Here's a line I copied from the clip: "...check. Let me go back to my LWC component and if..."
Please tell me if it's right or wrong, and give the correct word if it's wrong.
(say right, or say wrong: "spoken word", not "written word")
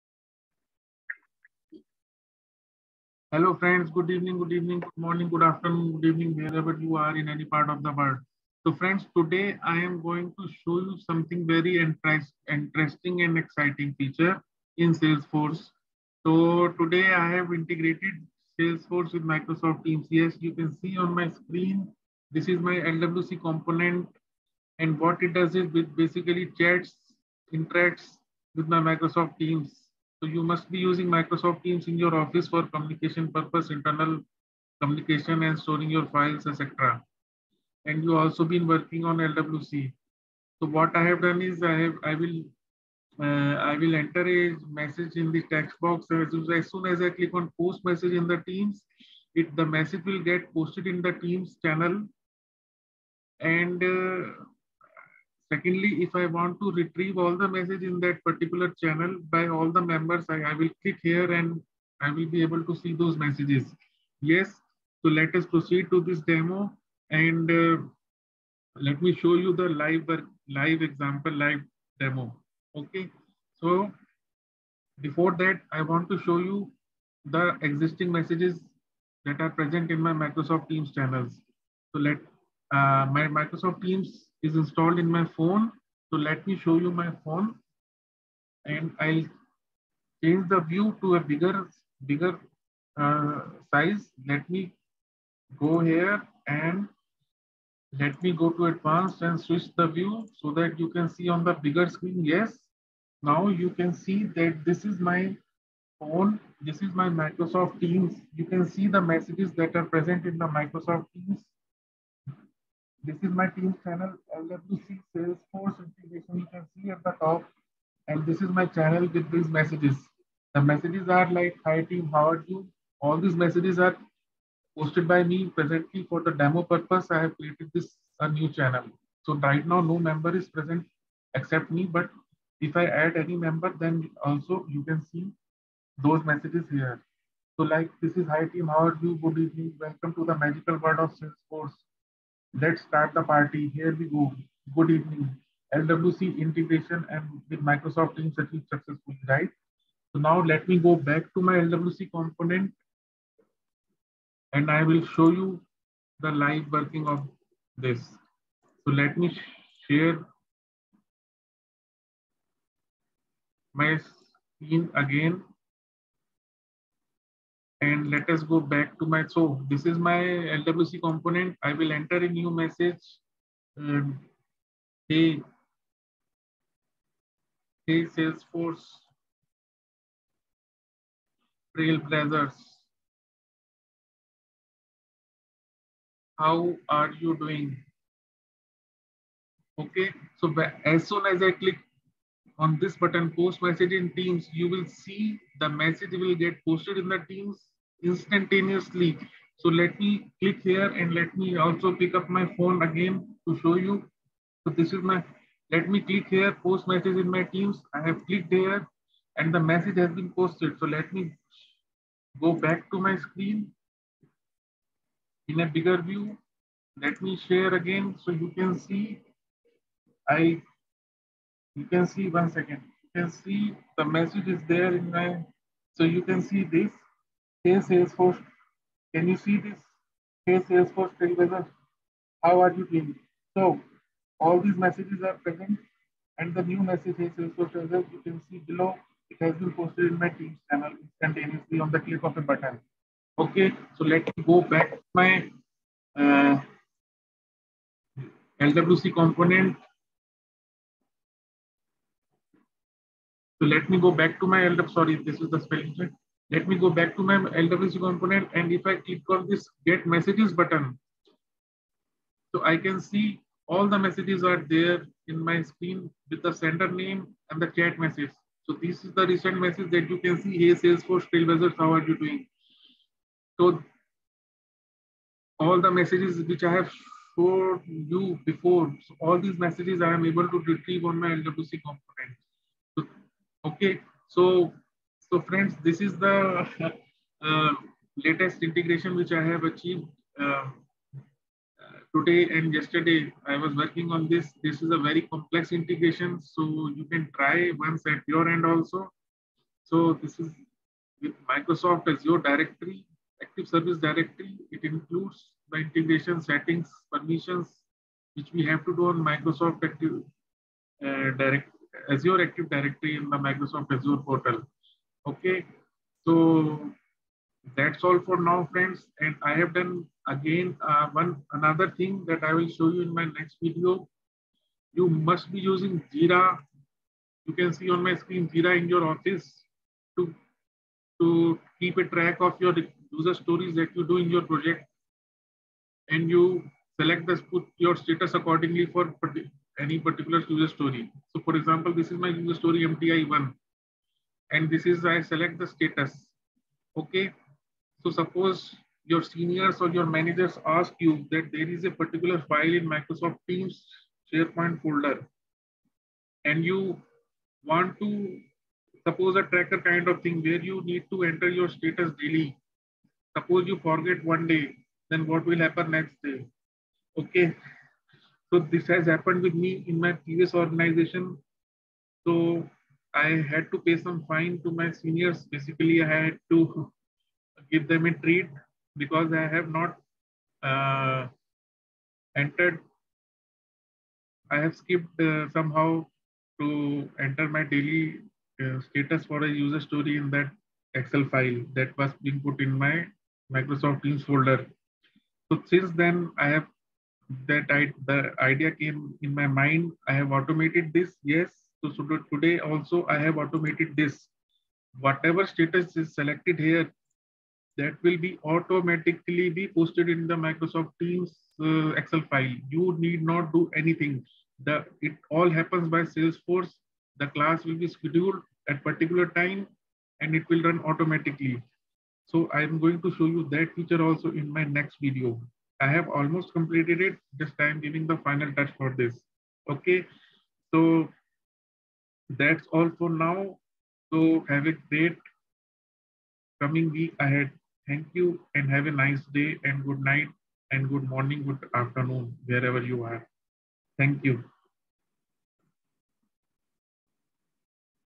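right.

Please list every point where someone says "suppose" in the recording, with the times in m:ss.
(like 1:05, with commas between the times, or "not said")
5:48, 5:59, 6:03.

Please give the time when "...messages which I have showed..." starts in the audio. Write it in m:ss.
4:35.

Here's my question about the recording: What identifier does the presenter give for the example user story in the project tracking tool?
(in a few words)
MTI1.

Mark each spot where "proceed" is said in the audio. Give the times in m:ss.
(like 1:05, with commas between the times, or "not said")
1:05.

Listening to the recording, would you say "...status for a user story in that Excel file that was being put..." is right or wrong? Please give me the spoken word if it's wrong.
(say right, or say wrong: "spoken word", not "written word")
right.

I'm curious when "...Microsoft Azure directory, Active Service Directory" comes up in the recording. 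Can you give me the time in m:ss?
5:01.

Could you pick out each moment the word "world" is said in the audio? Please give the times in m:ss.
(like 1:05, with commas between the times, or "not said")
0:07, 2:20.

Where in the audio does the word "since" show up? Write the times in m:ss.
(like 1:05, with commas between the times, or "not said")
6:35.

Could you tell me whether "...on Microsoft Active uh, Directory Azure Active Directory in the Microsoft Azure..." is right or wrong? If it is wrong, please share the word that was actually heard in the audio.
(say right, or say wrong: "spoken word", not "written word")
right.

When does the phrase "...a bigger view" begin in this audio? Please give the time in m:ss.
3:35.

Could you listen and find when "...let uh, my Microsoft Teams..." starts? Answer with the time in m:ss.
1:21.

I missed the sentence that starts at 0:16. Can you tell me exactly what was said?
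So today I have integrated Salesforce with Microsoft Teams.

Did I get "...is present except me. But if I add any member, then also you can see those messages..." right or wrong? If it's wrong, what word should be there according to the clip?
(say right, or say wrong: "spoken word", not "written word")
right.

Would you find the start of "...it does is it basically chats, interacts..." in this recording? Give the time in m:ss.
0:25.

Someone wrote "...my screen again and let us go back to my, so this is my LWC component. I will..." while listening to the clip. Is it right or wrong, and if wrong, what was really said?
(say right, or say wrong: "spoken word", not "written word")
right.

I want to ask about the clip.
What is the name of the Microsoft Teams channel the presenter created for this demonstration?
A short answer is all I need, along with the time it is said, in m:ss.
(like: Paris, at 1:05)
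LWC Salesforce integration, at 1:54.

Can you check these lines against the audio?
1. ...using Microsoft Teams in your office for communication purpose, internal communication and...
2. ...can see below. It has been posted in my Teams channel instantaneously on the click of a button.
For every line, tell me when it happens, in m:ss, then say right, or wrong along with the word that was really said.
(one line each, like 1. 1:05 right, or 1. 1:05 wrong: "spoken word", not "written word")
1. 0:30 right
2. 3:58 right.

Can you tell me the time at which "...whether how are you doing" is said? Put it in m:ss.
3:51.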